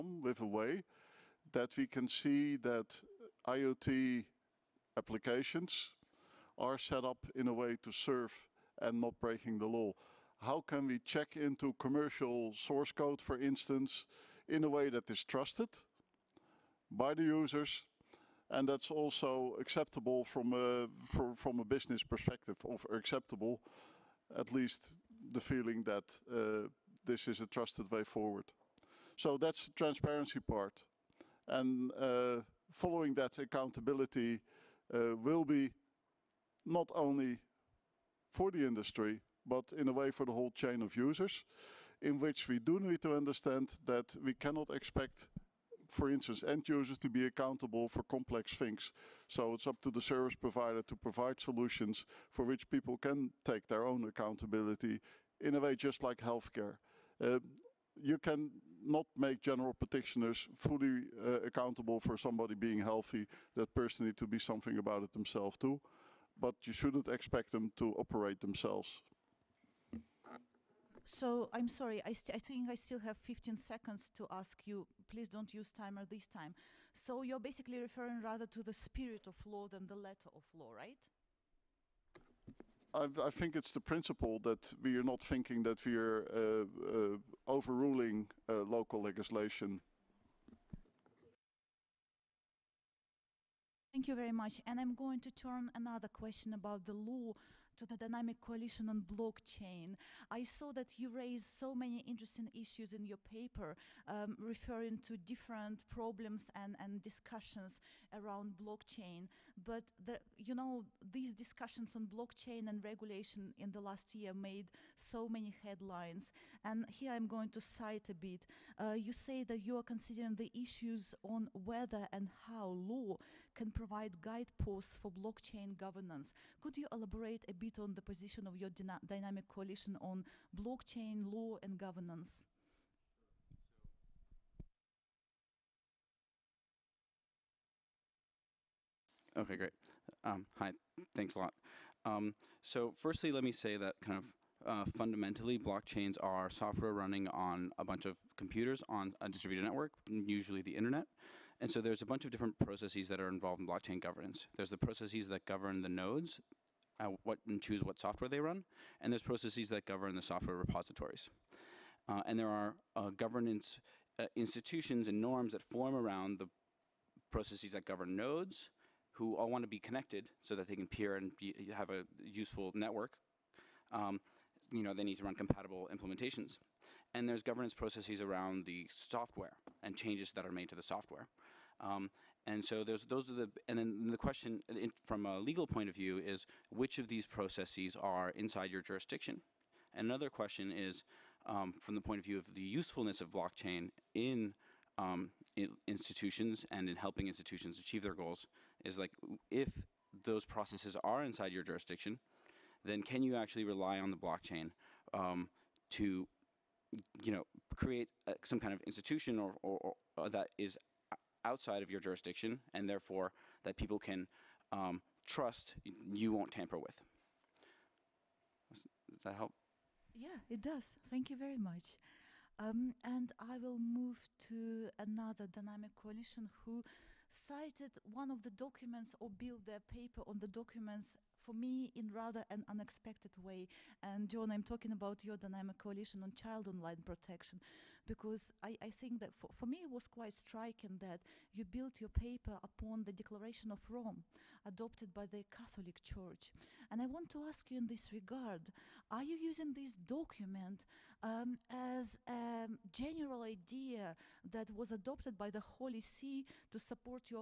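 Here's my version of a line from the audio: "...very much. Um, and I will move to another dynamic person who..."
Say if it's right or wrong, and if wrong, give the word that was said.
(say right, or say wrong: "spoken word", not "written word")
wrong: "coalition", not "person".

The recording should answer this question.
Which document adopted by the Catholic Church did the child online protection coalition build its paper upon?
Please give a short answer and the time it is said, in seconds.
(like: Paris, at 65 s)
Declaration of Rome, at 243 s.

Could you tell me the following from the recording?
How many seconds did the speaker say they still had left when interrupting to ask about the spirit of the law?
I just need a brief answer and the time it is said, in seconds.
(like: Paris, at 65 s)
15, at 73 s.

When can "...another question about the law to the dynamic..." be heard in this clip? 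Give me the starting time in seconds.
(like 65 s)
95 s.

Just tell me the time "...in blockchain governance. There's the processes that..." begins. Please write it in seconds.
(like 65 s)
153 s.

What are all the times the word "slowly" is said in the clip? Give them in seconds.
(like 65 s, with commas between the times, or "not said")
not said.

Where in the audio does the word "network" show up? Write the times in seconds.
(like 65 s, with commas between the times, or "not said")
149 s, 172 s.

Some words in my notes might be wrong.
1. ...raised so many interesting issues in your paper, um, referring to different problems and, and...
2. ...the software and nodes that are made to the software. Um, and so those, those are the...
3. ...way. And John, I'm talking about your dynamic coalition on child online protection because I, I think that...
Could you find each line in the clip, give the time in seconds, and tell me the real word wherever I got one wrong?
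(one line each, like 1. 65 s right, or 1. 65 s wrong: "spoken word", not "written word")
1. 101 s right
2. 178 s wrong: "changes", not "nodes"
3. 233 s right.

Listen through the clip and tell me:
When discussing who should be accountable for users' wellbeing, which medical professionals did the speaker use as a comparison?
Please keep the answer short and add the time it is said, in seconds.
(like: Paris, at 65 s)
General practitioners, at 59 s.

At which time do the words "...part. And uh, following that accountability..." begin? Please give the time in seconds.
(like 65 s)
30 s.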